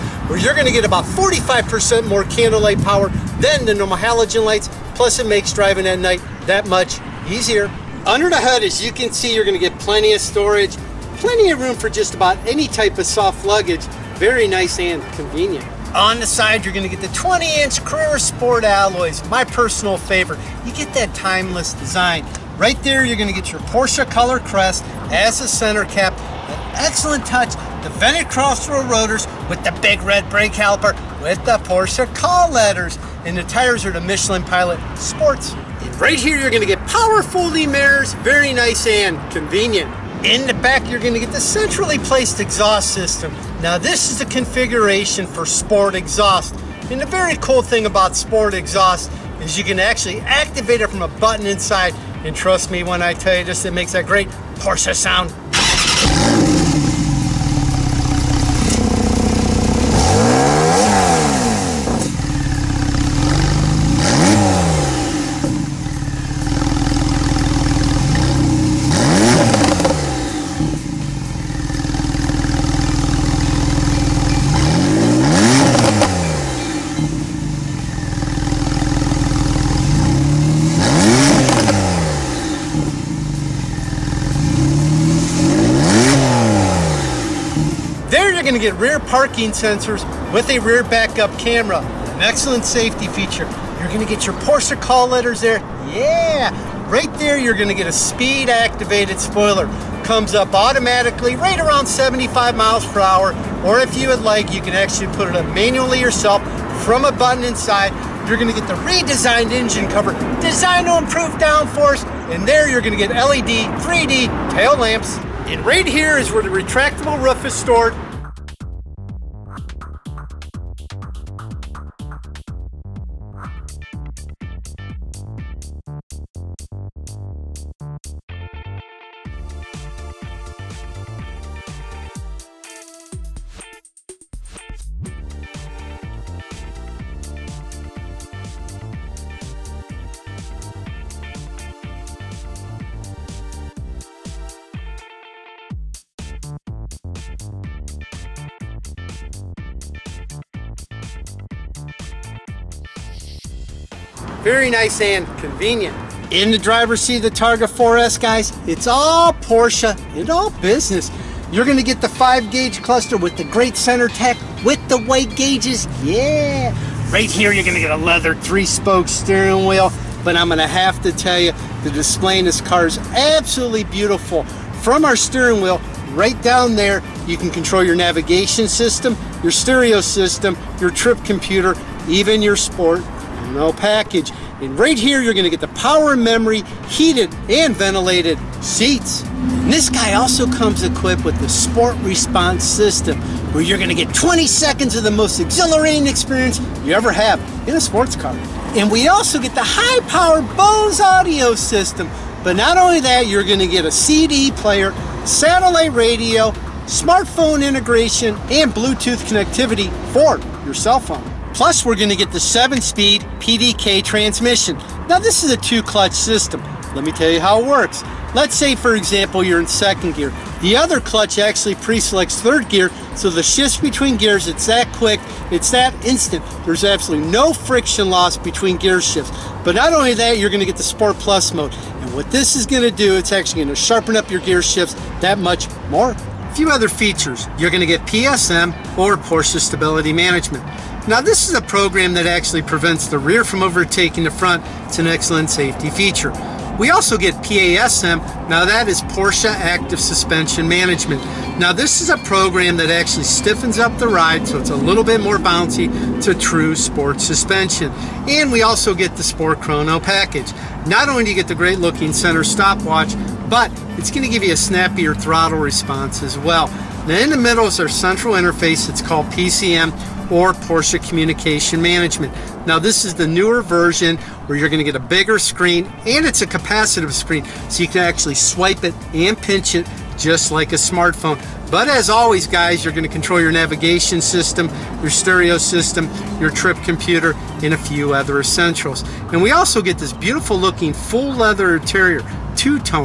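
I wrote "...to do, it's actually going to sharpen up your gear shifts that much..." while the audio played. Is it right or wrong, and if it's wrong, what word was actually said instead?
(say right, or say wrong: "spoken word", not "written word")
right.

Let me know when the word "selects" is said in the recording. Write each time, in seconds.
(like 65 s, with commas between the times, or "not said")
221 s.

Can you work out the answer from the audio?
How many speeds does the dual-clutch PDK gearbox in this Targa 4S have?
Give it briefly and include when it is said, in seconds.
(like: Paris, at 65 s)
7, at 212 s.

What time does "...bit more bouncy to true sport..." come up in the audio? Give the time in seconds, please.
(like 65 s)
255 s.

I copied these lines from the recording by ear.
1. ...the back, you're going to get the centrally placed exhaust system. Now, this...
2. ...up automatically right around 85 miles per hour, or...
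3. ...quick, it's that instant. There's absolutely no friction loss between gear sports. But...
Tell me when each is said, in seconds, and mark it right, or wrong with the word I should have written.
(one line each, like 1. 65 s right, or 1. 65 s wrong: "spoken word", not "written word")
1. 40 s right
2. 100 s wrong: "75", not "85"
3. 224 s wrong: "shifts", not "sports".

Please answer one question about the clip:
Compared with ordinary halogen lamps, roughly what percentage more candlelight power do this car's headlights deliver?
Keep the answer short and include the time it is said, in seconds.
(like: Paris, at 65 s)
45%, at 1 s.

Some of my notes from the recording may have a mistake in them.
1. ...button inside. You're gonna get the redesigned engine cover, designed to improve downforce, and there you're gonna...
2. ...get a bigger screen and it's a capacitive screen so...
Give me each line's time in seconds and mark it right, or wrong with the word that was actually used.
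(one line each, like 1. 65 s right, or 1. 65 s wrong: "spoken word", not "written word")
1. 107 s right
2. 274 s right.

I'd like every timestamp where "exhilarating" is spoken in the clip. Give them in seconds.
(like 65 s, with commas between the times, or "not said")
195 s.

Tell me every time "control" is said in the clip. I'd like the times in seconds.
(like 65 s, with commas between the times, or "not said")
177 s, 283 s.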